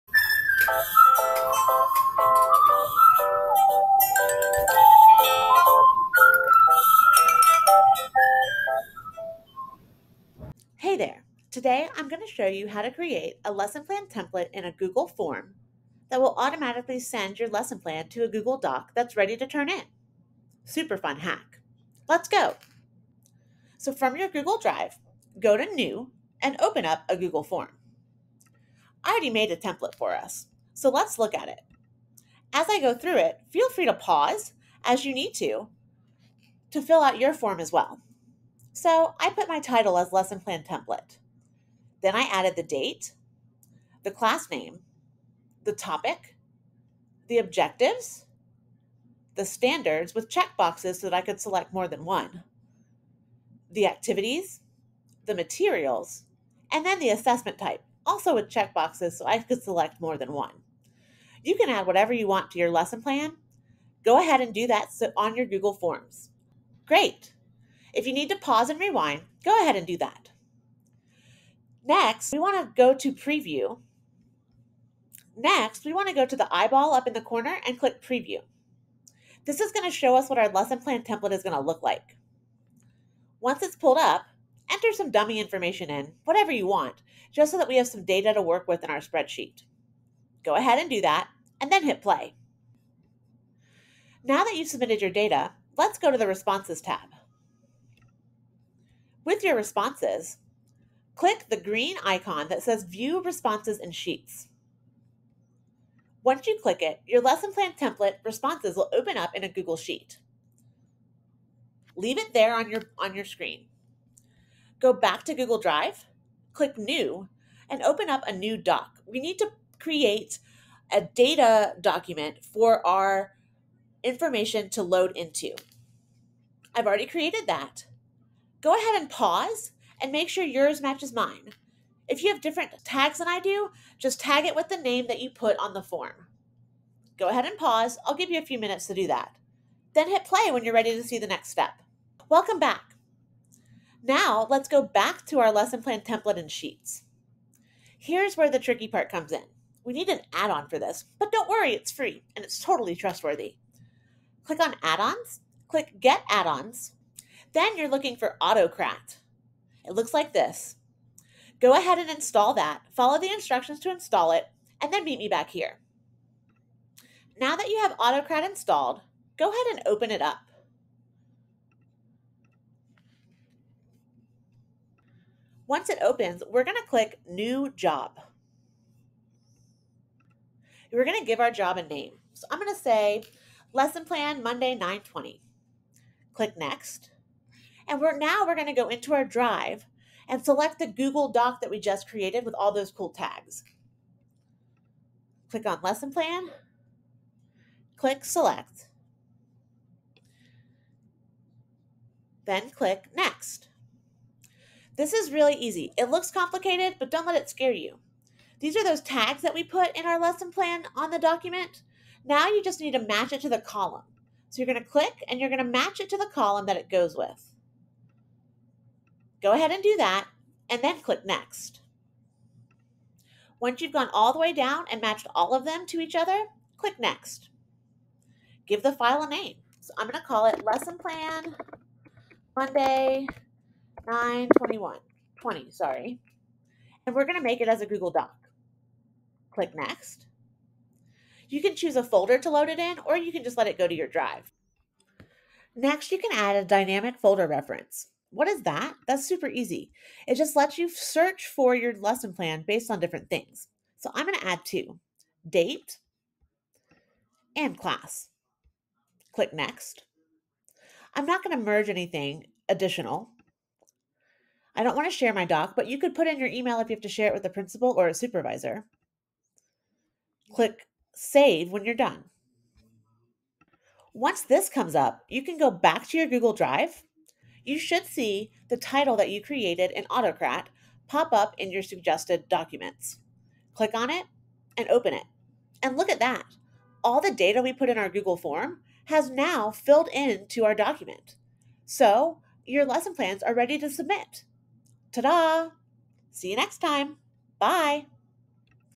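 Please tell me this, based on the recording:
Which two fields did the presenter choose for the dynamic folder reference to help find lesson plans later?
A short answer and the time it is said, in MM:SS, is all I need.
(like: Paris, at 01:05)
Date and class, at 04:15.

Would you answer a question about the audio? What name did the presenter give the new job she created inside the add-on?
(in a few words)
Lesson Plan Monday 920.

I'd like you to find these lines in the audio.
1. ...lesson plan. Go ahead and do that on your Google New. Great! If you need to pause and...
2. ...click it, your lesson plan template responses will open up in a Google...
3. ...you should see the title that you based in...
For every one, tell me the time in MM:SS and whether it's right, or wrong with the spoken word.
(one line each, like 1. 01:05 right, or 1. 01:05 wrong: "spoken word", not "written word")
1. 01:02 wrong: "Forms", not "New"
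2. 01:46 right
3. 04:37 wrong: "created", not "based".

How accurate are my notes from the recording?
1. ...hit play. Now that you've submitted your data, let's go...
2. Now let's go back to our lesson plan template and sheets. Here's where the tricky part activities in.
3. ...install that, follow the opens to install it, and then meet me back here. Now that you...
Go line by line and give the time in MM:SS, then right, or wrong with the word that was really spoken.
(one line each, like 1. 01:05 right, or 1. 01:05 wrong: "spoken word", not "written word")
1. 01:31 right
2. 02:24 wrong: "comes", not "activities"
3. 02:42 wrong: "instructions", not "opens".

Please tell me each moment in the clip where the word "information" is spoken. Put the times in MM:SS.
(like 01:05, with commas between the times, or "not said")
01:25, 02:04.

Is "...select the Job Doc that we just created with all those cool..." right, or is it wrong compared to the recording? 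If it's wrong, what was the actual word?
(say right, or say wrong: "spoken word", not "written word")
wrong: "Google", not "Job".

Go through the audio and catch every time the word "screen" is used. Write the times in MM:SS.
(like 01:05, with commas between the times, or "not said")
01:53.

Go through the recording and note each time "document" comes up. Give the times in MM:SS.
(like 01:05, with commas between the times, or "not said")
02:01, 03:31, 04:42, 04:50.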